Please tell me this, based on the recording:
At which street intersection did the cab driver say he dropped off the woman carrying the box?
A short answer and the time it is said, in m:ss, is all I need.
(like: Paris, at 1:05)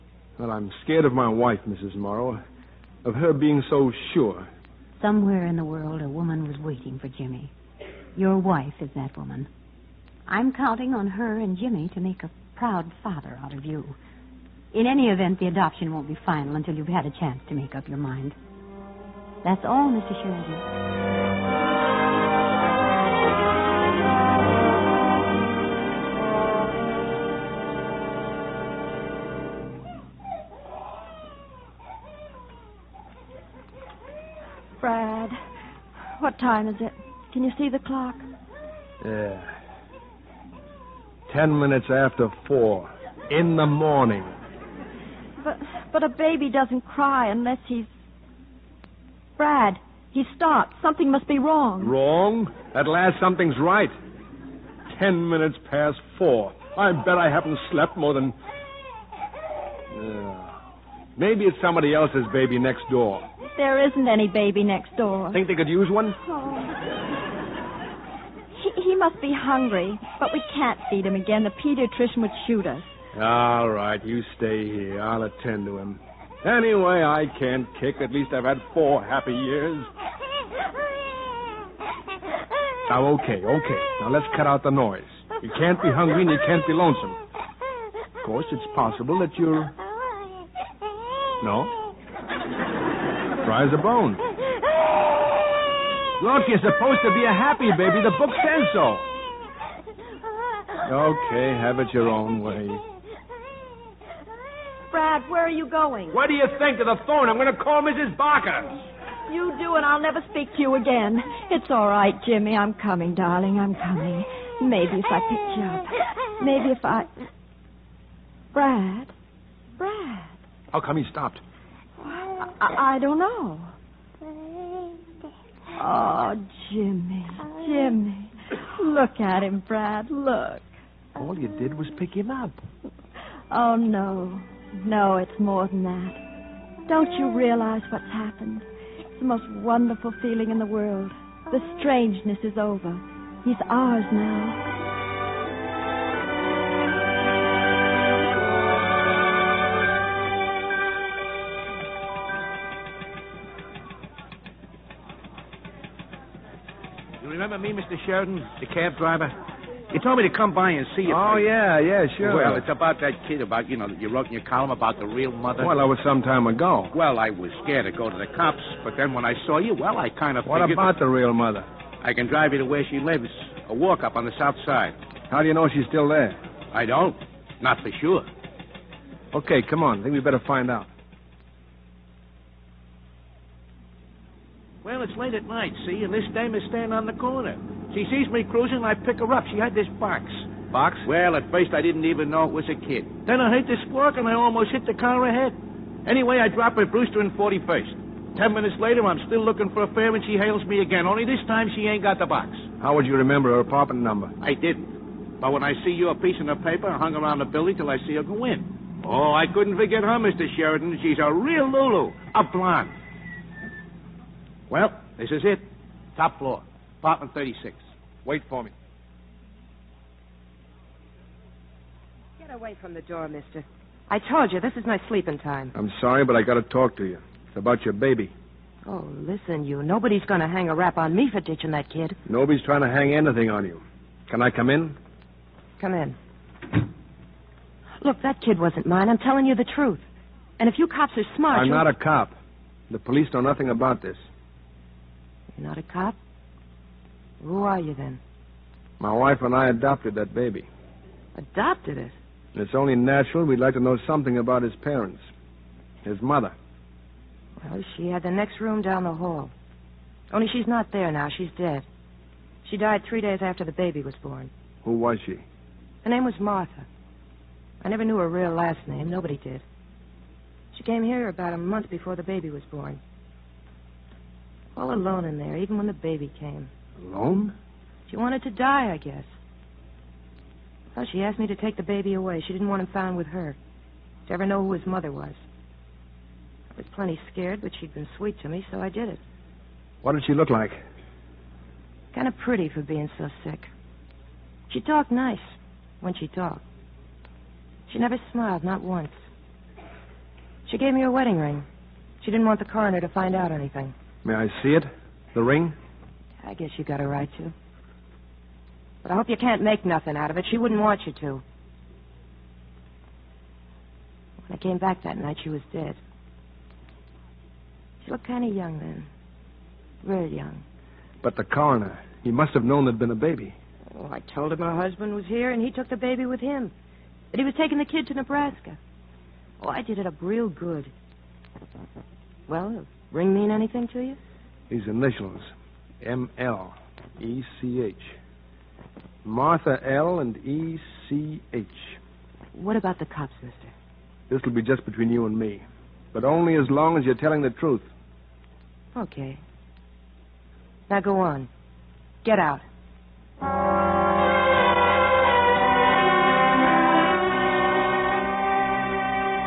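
Brewster and 41st, at 3:16.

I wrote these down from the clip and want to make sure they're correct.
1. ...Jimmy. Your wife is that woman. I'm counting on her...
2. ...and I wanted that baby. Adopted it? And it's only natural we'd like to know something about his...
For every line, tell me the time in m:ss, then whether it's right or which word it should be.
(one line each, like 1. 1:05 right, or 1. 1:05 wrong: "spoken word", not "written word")
1. 0:07 right
2. 4:09 wrong: "adopted", not "wanted".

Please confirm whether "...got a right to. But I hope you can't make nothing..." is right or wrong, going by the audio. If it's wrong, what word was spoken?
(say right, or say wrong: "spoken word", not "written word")
right.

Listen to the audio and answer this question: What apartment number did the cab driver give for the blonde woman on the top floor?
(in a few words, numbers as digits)
36.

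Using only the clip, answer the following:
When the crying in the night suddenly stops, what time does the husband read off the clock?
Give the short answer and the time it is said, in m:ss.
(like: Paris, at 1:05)
4:10, at 0:41.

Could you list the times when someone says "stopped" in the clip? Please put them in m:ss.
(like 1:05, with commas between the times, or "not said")
0:50, 2:01.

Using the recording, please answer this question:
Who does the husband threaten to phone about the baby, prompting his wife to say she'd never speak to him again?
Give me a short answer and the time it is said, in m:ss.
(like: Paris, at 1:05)
Mrs. Barker, at 1:47.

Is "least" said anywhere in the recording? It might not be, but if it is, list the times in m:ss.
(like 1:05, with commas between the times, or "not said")
1:18.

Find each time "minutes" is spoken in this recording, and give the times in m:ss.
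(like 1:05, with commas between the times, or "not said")
0:41, 0:55, 3:18.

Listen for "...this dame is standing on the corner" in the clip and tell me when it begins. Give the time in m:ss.
3:06.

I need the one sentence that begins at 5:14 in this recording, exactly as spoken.
When I came back that night, she was dead.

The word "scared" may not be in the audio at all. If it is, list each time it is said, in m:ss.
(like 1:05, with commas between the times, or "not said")
0:00, 2:47, 4:47.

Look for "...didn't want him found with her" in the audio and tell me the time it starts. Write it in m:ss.
4:42.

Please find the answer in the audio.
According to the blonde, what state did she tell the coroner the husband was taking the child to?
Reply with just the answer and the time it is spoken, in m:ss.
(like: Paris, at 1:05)
Nebraska, at 5:28.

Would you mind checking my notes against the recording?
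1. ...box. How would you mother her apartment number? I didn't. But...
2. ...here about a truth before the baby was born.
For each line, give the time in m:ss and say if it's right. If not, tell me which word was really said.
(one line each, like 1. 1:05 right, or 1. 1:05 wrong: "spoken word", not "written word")
1. 3:22 wrong: "remember", not "mother"
2. 4:31 wrong: "month", not "truth".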